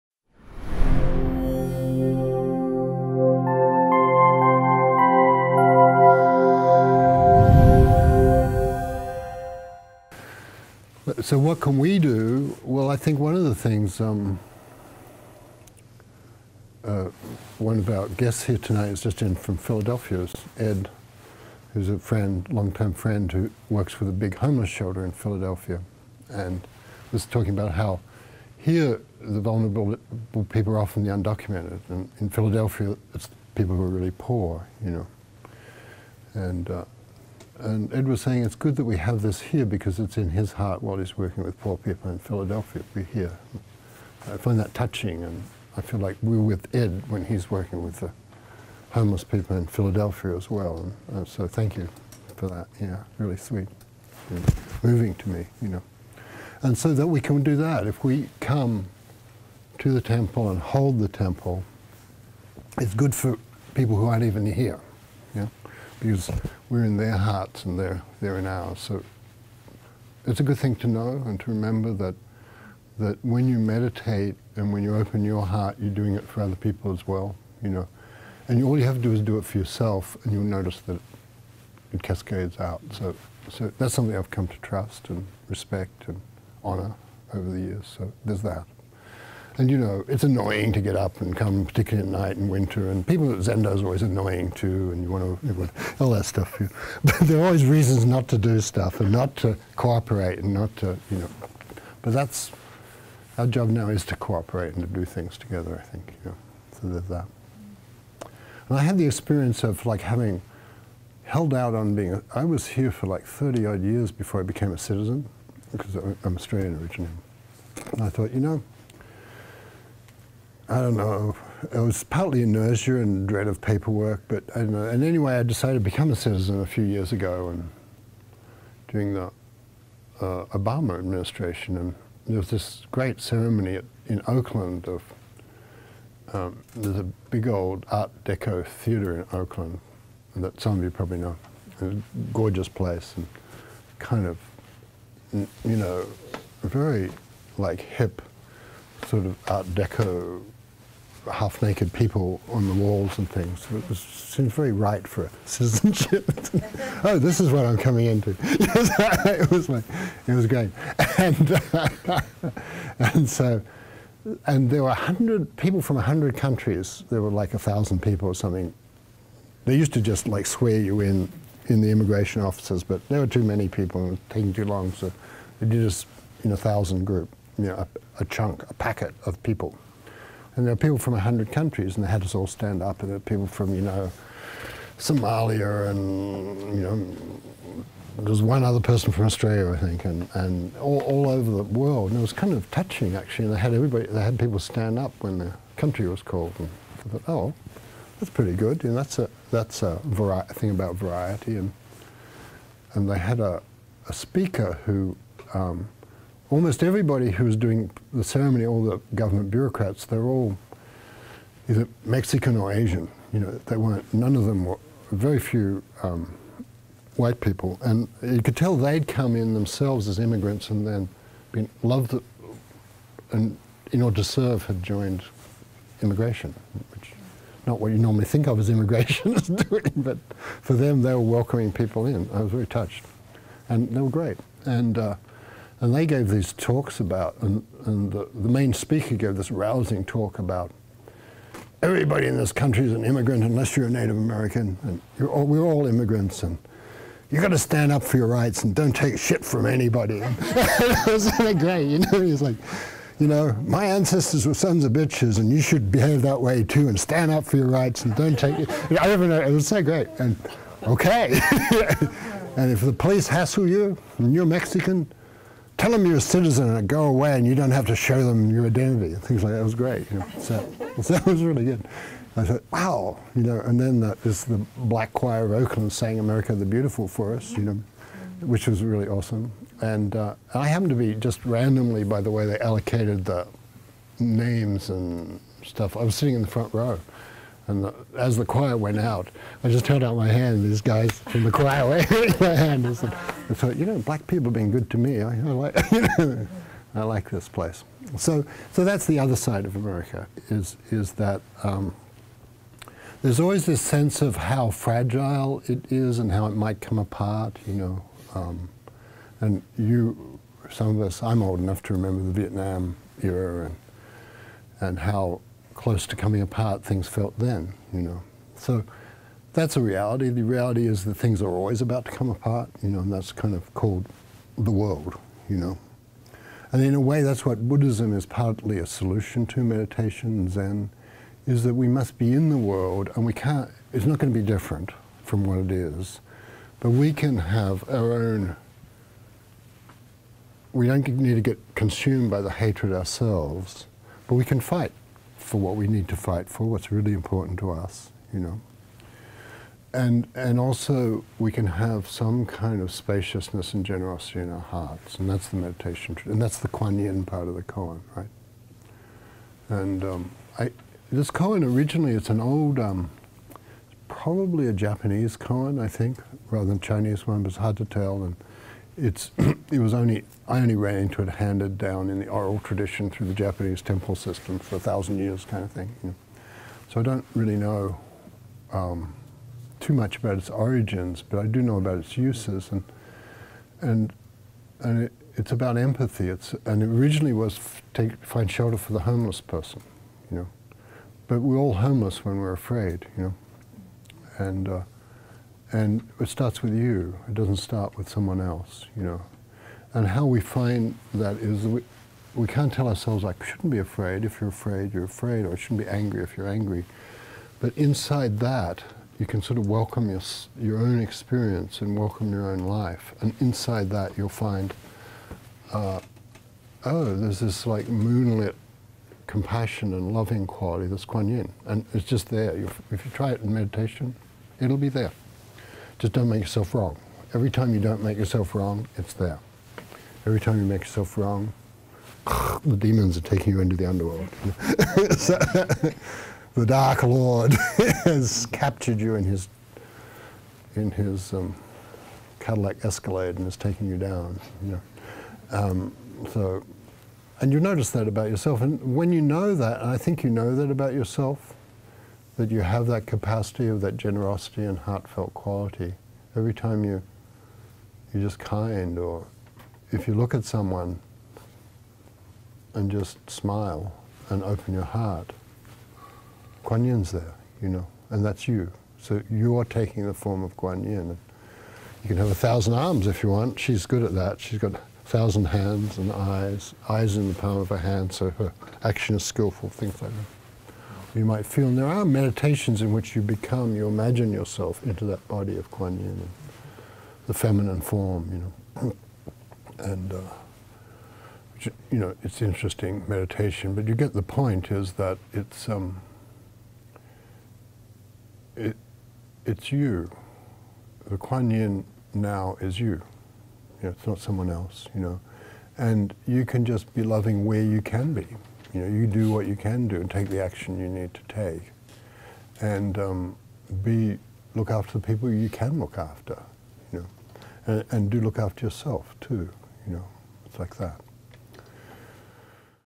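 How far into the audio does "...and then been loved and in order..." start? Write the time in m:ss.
3:40.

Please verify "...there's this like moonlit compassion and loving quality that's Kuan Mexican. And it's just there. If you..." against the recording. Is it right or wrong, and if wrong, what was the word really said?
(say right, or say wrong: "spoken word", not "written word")
wrong: "Yin", not "Mexican".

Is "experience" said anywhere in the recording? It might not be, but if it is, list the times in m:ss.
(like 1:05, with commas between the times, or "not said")
1:49, 6:50.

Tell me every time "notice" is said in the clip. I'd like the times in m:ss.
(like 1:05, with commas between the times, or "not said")
1:20, 7:27.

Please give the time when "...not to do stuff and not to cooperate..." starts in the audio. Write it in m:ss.
1:38.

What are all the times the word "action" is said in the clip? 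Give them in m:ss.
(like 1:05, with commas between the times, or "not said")
7:58, 8:30.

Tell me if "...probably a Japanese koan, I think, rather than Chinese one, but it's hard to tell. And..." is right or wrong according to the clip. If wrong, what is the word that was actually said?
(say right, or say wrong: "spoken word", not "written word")
right.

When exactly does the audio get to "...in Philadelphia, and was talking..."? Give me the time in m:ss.
0:25.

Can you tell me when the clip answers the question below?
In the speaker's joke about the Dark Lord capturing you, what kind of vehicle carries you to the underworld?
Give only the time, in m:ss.
7:22.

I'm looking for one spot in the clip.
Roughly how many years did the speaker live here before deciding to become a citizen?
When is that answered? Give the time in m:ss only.
1:53.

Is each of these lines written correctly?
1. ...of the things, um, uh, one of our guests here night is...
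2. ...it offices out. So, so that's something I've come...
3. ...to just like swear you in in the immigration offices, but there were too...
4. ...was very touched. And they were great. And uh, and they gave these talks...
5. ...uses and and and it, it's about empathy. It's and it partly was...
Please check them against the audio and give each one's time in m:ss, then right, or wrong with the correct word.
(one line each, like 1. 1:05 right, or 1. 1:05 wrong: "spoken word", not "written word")
1. 0:13 wrong: "tonight", not "night"
2. 1:21 wrong: "cascades", not "offices"
3. 2:49 right
4. 3:52 right
5. 6:22 wrong: "originally", not "partly".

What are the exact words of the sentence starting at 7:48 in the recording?
So you're taking the form of Guan Yin.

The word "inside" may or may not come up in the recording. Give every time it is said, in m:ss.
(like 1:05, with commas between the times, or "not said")
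6:47, 6:53.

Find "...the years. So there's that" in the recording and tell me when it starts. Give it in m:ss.
1:27.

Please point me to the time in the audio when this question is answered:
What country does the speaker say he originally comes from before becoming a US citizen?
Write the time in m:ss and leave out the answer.
1:56.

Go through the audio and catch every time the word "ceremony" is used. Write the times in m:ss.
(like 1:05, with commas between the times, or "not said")
2:13, 3:28.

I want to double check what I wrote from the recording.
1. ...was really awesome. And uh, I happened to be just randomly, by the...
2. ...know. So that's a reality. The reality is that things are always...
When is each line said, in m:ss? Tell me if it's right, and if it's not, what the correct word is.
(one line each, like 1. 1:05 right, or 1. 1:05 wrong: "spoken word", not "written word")
1. 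4:38 right
2. 5:18 right.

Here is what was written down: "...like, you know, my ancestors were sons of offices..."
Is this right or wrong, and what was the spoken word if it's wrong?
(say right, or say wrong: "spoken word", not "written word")
wrong: "bitches", not "offices".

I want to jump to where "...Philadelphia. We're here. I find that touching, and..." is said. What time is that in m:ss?
0:42.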